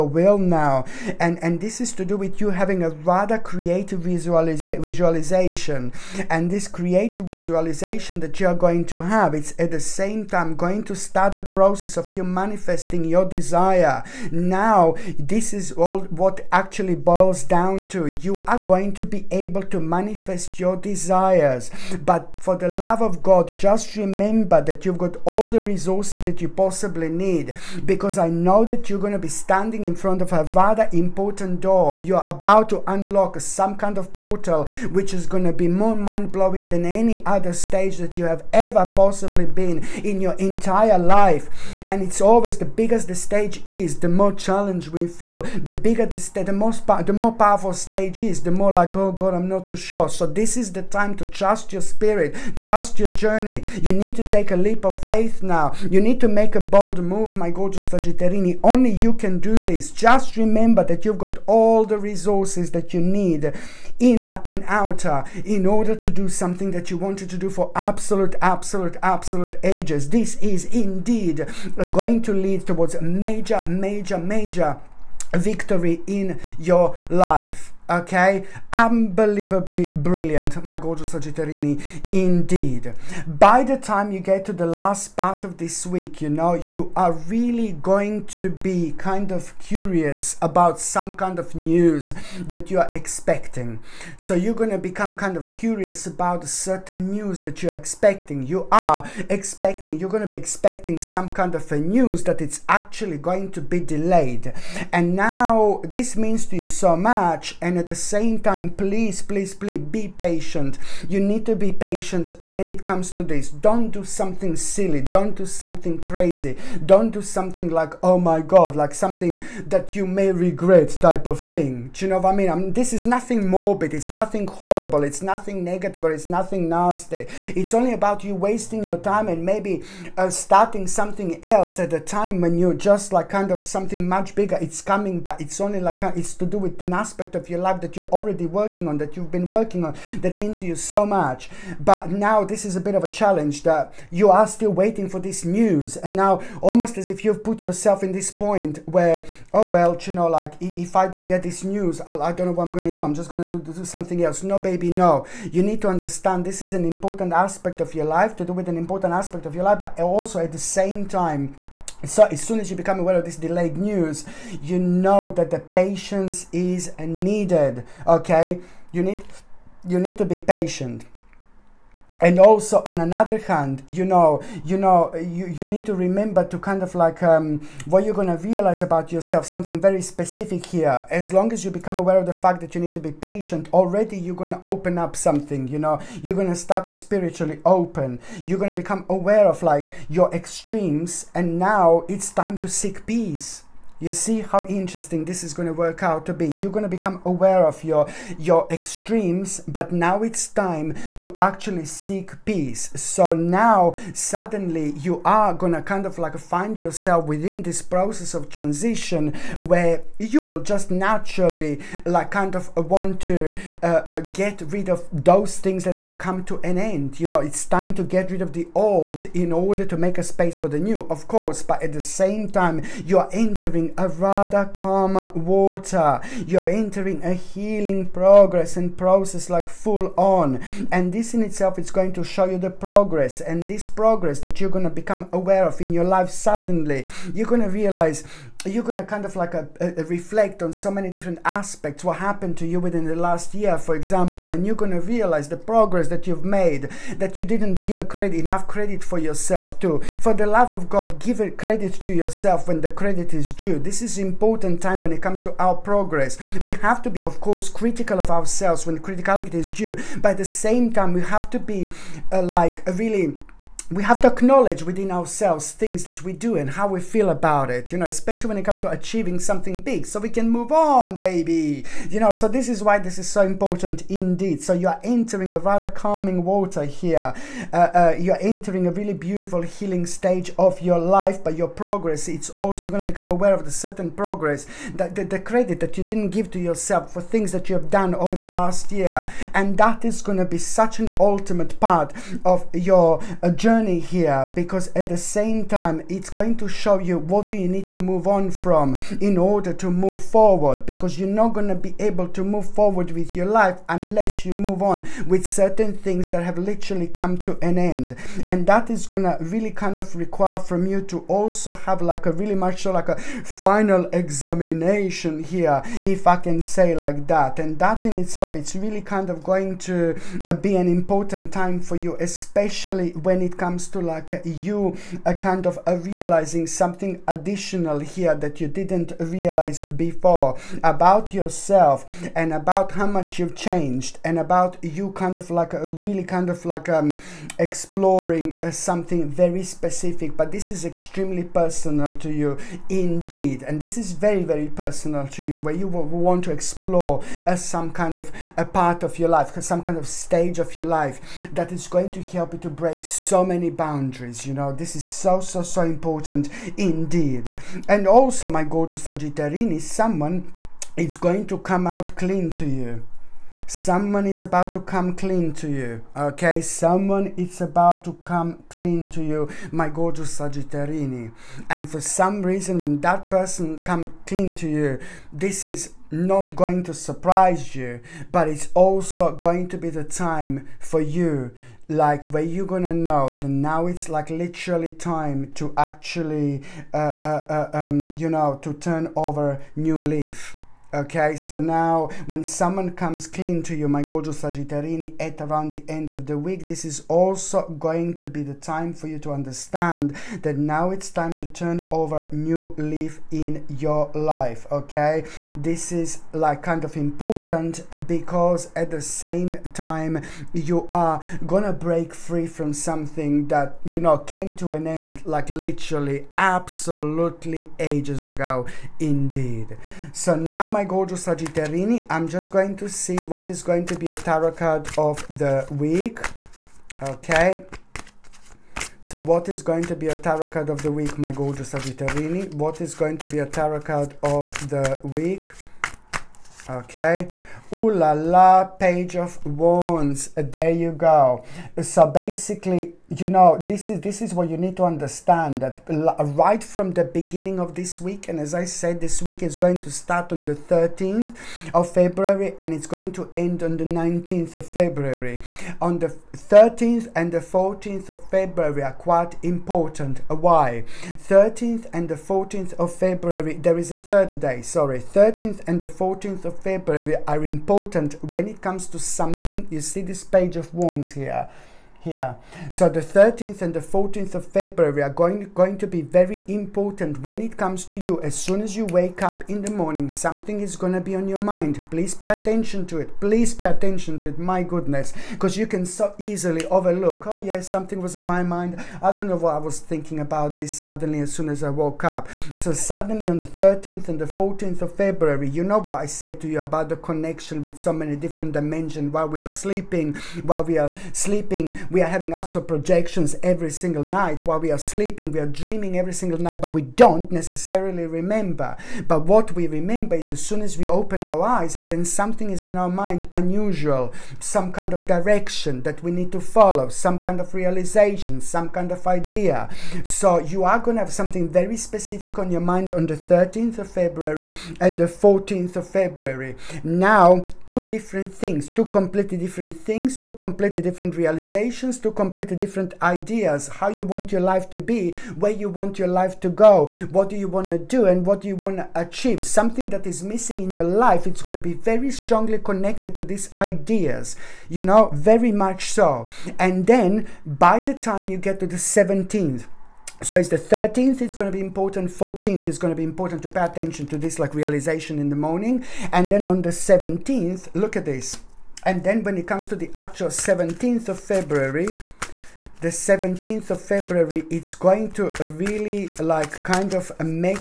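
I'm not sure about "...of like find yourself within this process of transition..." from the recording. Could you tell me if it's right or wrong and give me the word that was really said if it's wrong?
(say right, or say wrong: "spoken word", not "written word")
right.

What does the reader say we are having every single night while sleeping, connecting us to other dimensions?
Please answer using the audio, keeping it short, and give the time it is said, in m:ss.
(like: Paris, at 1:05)
astral projections, at 8:22.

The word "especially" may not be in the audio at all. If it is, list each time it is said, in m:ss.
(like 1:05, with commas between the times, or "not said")
4:28, 5:22.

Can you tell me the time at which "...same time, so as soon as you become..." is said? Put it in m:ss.
2:40.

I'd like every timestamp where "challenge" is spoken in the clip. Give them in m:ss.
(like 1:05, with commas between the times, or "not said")
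0:44, 2:23.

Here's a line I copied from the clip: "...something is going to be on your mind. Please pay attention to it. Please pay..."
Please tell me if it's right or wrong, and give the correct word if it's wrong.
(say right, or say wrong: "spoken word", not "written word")
right.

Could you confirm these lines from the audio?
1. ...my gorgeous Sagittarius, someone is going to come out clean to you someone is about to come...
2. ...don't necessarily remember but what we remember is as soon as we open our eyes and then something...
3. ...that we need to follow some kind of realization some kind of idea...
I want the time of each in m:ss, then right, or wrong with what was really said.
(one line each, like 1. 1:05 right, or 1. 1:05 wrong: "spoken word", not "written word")
1. 5:58 right
2. 8:26 right
3. 8:35 right.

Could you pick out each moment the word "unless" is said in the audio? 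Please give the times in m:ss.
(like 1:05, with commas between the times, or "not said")
5:03.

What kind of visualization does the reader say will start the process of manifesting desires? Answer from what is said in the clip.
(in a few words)
creative visualization.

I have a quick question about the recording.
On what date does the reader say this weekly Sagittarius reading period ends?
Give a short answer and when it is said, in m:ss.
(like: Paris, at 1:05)
19th of February, at 7:33.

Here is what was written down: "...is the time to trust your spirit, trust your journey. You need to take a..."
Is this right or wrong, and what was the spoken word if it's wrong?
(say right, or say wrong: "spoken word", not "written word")
right.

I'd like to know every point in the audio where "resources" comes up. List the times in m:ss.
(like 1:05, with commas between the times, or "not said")
0:25, 1:01.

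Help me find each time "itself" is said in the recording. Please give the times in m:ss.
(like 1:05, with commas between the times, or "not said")
3:51, 5:18.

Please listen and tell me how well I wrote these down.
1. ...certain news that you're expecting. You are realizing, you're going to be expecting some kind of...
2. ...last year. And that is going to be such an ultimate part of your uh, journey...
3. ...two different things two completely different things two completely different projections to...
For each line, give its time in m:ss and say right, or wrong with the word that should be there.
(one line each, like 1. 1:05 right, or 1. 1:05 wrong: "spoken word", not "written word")
1. 1:36 wrong: "expecting", not "realizing"
2. 4:48 right
3. 8:47 wrong: "realizations", not "projections".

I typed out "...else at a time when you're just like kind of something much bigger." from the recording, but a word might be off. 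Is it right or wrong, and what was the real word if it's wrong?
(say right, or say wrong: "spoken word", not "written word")
right.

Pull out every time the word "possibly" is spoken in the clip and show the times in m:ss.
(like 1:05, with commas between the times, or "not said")
0:26, 0:38.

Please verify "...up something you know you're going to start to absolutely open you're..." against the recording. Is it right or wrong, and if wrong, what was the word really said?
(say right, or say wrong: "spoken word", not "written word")
wrong: "spiritually", not "absolutely".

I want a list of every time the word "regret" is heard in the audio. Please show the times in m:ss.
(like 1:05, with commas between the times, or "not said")
2:00.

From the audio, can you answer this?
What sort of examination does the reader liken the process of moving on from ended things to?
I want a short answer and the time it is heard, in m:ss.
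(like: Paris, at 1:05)
final examination, at 5:13.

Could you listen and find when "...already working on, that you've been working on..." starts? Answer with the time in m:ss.
2:18.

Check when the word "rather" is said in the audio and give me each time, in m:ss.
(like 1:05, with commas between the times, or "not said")
0:02, 0:30, 3:44, 4:35.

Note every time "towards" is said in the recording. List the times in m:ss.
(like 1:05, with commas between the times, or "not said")
1:12.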